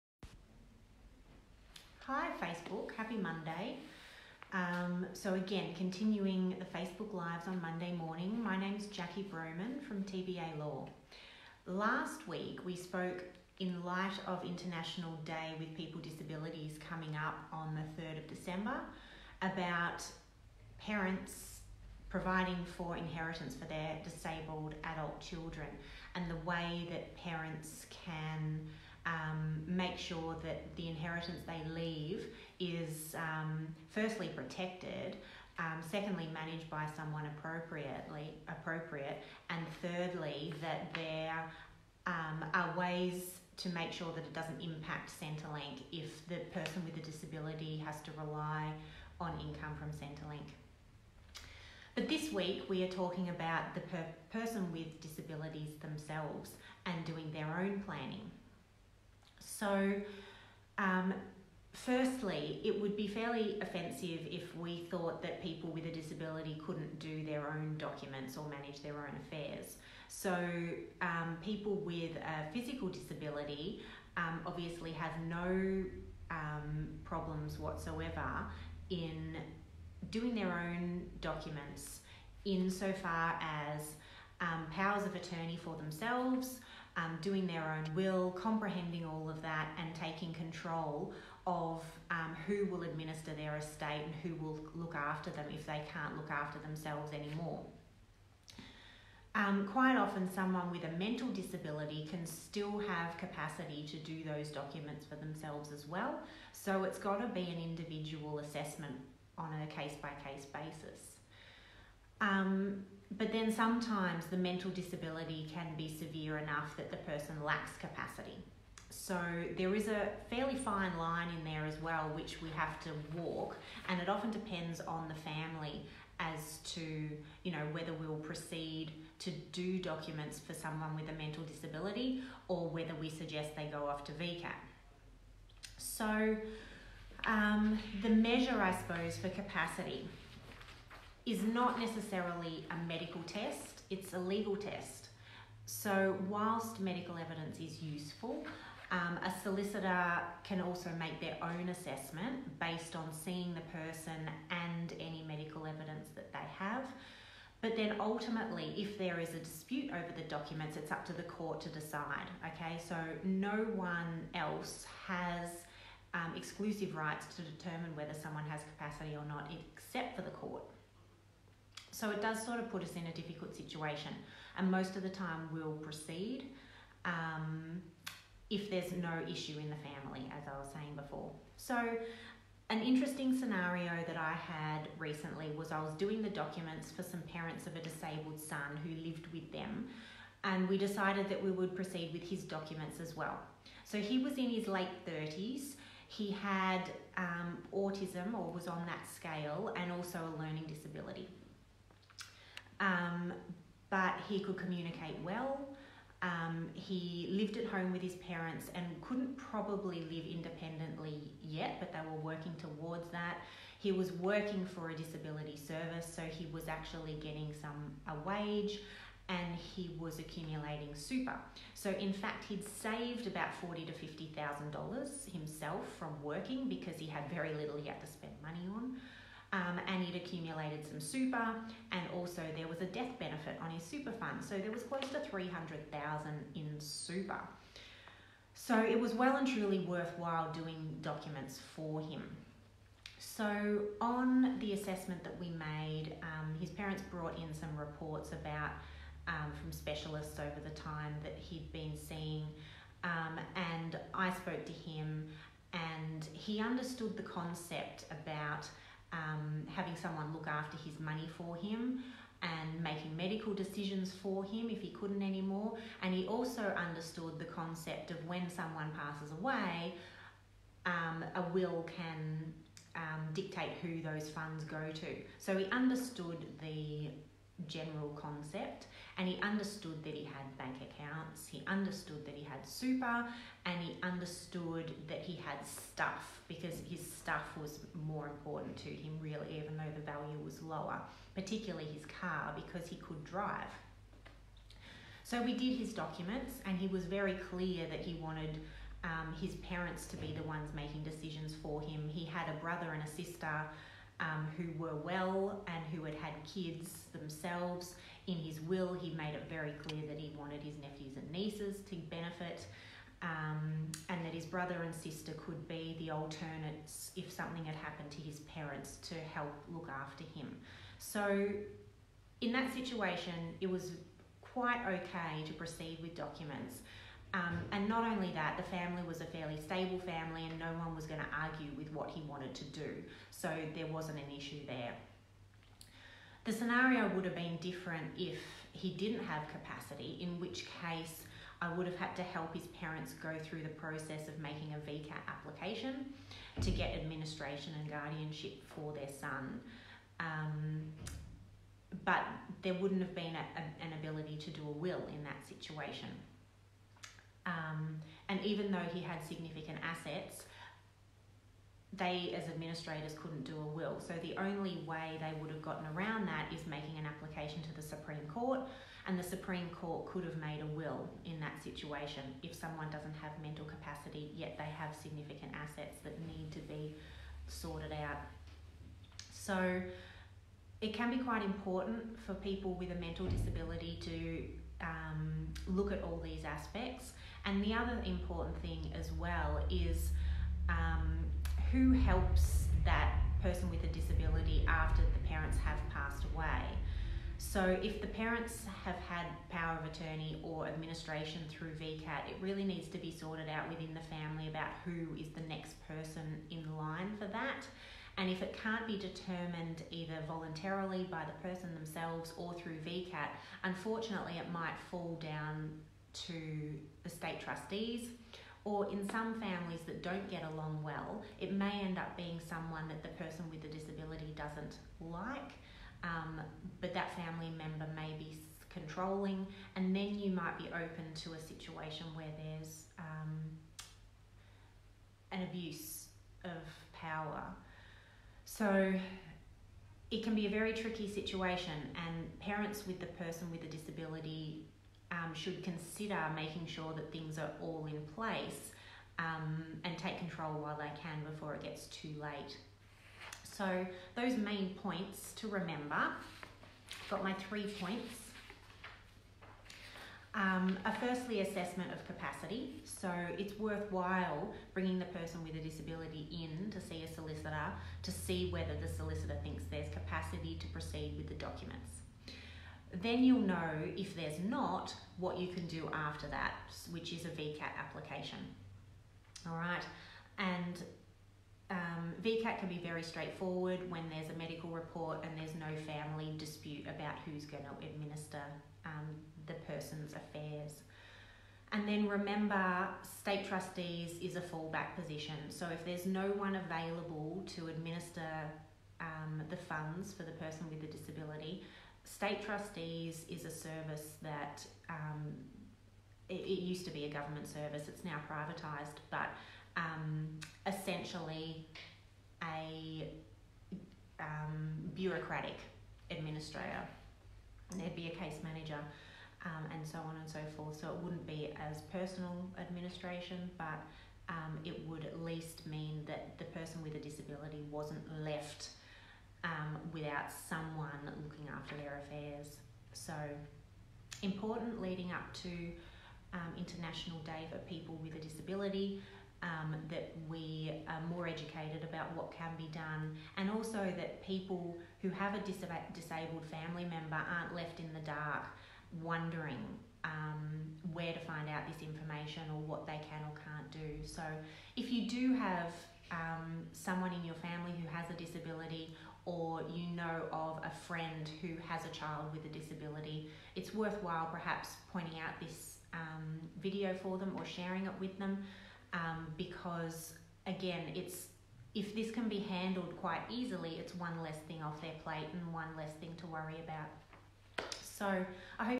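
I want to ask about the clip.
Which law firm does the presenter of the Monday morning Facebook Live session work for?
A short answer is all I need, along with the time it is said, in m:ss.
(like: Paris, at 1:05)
TBA Law, at 0:10.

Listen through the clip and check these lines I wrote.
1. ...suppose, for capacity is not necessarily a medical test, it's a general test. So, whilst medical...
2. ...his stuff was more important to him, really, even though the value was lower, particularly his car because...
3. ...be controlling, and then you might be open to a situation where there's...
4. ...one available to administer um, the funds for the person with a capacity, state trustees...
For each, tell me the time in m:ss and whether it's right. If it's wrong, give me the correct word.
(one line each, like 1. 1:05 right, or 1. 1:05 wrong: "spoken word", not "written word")
1. 2:18 wrong: "legal", not "general"
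2. 4:46 right
3. 7:08 right
4. 8:16 wrong: "disability", not "capacity".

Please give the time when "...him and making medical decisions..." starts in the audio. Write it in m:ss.
4:21.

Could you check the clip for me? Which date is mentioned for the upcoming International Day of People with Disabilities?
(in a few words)
3rd of December.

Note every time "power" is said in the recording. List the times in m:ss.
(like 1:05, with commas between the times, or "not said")
1:24, 6:39, 7:16.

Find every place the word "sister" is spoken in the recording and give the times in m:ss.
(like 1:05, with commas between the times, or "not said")
5:03, 5:14.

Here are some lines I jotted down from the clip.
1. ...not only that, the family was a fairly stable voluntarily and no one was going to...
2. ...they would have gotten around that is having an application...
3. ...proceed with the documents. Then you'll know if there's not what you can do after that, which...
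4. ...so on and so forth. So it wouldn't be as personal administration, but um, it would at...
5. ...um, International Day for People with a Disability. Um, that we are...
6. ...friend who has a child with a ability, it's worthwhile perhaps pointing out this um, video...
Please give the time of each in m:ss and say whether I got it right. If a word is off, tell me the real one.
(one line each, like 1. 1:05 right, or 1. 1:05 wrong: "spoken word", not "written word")
1. 5:27 wrong: "family", not "voluntarily"
2. 6:05 wrong: "making", not "having"
3. 7:50 right
4. 8:39 right
5. 8:56 right
6. 9:20 wrong: "disability", not "ability".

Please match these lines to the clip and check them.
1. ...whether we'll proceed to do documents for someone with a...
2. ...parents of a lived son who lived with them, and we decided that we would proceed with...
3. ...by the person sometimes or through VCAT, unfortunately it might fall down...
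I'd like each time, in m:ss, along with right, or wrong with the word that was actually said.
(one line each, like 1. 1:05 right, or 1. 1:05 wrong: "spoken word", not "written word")
1. 2:07 right
2. 3:07 wrong: "disabled", not "lived"
3. 6:51 wrong: "themselves", not "sometimes".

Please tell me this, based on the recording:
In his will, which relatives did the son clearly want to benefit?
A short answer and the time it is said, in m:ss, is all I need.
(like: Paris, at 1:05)
nephews and nieces, at 5:10.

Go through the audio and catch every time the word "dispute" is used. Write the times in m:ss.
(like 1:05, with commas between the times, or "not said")
2:39, 8:06.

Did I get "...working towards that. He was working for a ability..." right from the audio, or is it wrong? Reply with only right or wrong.
wrong.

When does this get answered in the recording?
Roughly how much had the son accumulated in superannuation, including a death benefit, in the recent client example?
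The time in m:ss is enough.
3:55.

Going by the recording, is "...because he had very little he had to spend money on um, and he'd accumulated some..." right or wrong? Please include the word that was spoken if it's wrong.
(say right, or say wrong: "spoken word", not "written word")
right.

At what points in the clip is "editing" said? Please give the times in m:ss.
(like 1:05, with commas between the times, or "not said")
not said.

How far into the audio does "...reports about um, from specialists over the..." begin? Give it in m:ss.
4:07.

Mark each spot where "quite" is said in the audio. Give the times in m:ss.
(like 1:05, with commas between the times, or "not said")
1:39, 5:24, 6:21, 9:32.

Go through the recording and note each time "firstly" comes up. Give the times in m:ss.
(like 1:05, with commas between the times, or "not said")
0:33, 1:01, 7:40.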